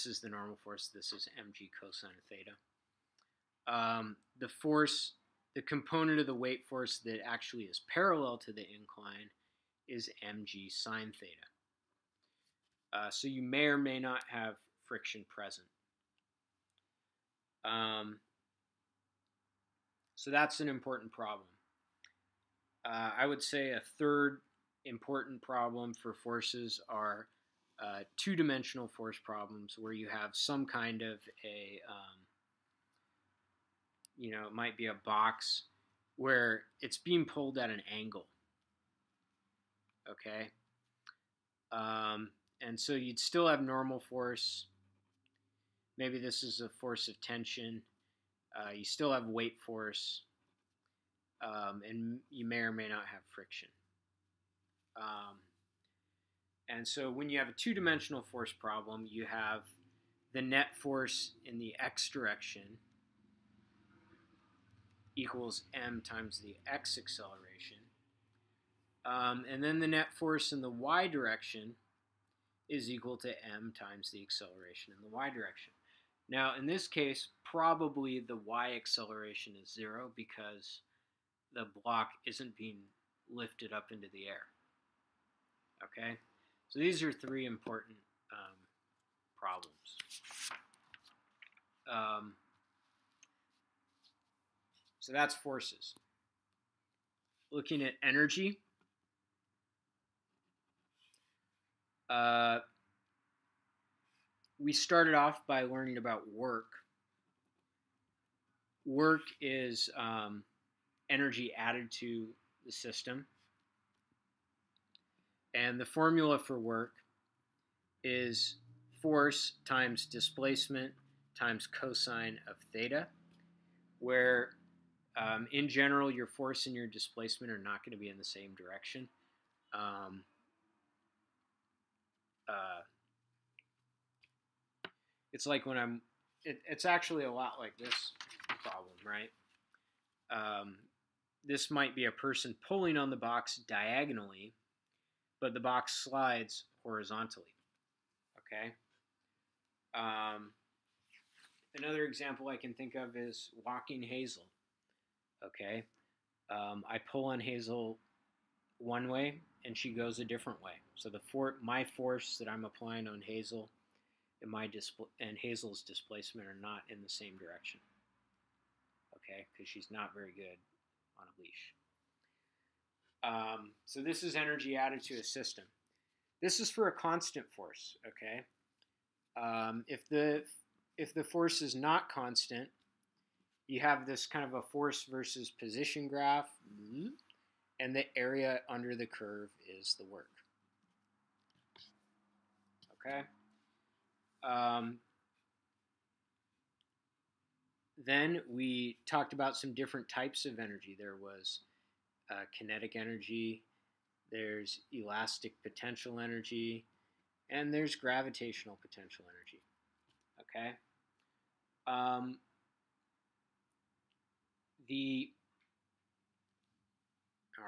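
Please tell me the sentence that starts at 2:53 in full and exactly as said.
Um, so this is energy added to a system.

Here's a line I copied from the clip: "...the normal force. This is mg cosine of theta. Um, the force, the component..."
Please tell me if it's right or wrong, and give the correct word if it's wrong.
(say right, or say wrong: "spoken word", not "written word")
right.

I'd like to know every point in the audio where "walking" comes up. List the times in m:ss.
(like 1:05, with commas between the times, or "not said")
2:33.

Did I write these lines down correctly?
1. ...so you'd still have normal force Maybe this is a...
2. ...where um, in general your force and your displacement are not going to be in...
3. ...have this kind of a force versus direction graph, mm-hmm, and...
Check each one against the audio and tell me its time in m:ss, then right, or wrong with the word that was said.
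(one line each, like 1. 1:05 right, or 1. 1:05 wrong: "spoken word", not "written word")
1. 0:42 right
2. 2:03 right
3. 3:03 wrong: "position", not "direction".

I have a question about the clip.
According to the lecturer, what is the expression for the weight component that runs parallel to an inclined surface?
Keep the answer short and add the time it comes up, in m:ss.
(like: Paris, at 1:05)
mg sine theta, at 0:10.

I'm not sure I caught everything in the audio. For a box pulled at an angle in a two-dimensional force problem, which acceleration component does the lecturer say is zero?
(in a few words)
The y acceleration.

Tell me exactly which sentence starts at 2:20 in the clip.
Um, this might be a person pulling on the box diagonally, but the box slides horizontally, okay?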